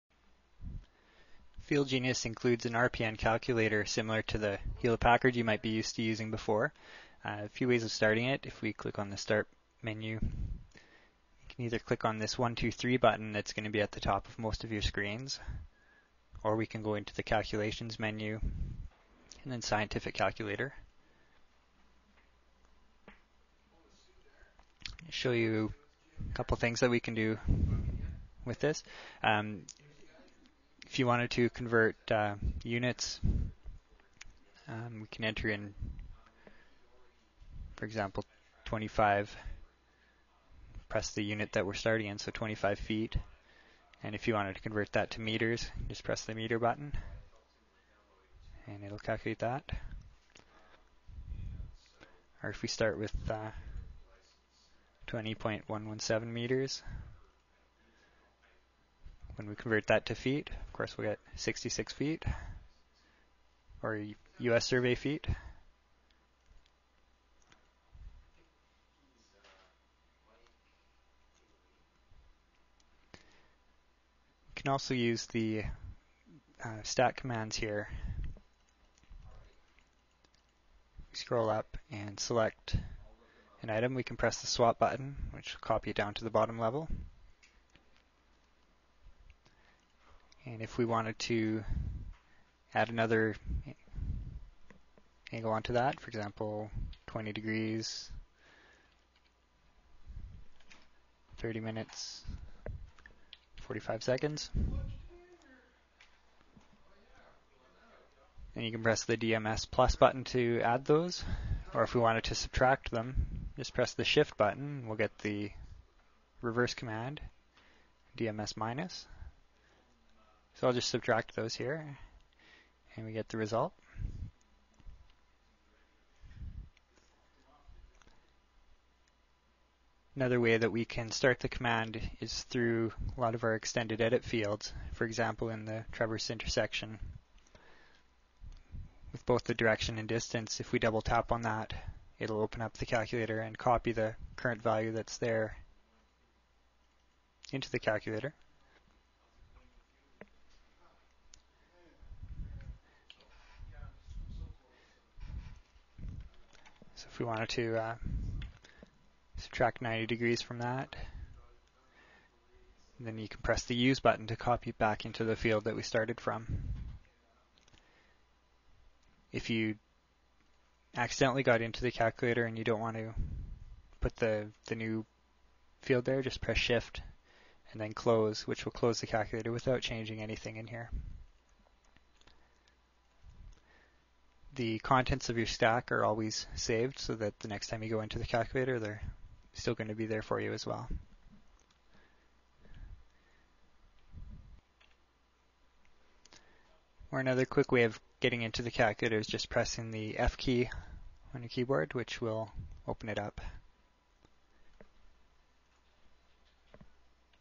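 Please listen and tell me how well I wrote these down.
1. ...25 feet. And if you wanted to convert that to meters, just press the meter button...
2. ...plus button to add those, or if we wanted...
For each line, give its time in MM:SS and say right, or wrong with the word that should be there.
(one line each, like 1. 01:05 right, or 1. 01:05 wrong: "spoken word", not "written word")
1. 00:42 right
2. 01:49 right.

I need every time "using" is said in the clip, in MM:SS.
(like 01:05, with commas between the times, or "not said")
00:06.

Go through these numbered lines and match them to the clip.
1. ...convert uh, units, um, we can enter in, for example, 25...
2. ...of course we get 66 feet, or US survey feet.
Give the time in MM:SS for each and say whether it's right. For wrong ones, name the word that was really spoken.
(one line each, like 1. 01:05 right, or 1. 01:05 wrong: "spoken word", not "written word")
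1. 00:31 right
2. 01:00 right.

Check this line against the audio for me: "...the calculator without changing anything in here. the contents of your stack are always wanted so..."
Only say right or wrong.
wrong.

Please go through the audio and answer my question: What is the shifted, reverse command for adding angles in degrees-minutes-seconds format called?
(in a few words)
DMS minus.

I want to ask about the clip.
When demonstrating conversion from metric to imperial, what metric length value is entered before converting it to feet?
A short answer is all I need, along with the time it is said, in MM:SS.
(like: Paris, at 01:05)
20.117 meters, at 00:55.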